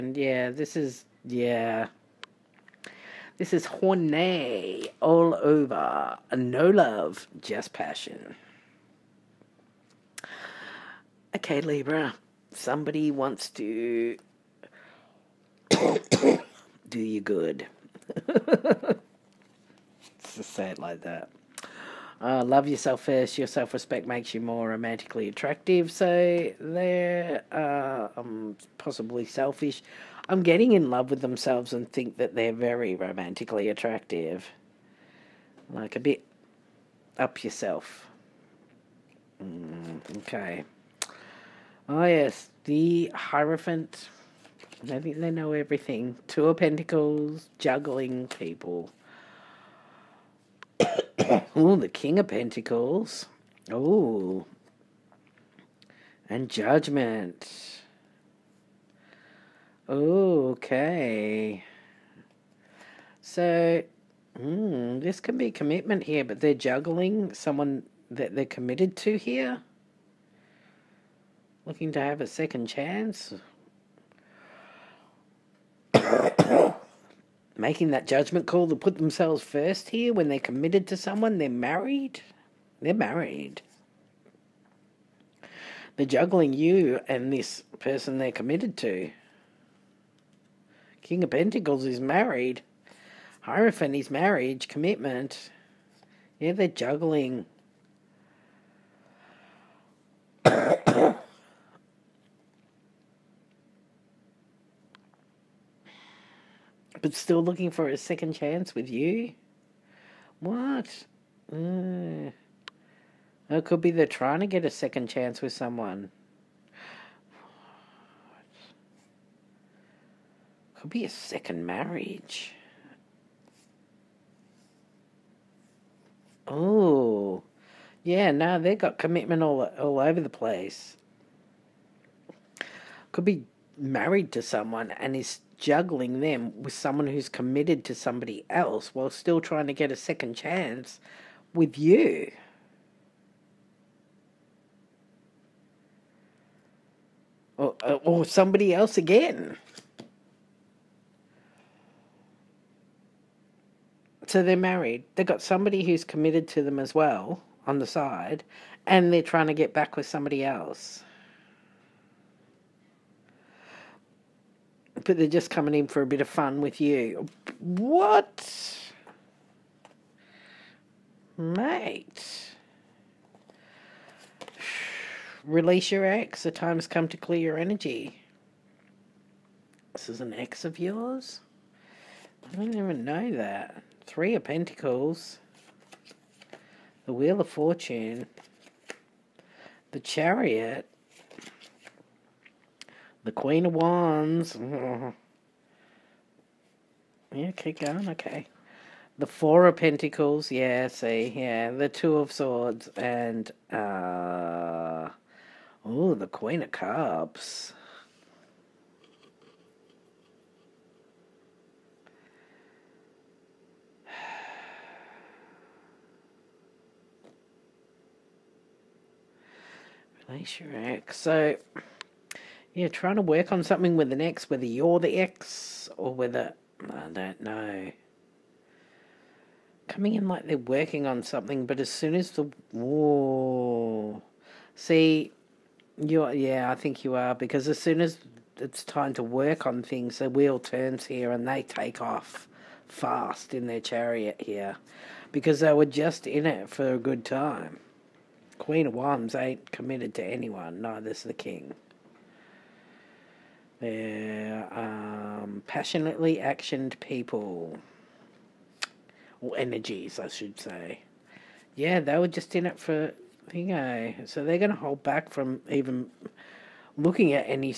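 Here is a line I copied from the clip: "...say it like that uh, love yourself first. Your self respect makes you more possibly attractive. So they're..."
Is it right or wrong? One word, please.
wrong.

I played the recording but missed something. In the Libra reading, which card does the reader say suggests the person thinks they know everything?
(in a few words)
The Hierophant.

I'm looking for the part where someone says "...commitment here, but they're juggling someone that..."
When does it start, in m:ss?
1:05.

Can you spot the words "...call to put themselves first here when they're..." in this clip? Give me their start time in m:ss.
1:18.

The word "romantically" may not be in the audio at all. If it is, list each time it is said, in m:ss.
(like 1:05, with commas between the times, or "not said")
0:24, 0:32.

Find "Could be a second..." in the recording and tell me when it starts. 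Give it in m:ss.
2:00.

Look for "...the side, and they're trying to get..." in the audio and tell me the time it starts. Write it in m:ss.
2:37.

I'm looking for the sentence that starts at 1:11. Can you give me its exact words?
Looking to have a second chance.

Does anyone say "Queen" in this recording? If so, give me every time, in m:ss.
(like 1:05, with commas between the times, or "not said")
3:13, 3:26, 4:08.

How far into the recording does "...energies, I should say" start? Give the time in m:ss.
4:19.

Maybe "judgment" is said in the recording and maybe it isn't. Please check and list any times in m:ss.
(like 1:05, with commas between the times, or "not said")
0:56, 1:18.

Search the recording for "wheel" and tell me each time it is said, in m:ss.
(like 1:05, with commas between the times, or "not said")
3:07, 4:00.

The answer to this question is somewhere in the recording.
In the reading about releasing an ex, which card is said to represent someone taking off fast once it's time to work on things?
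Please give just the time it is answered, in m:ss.
3:09.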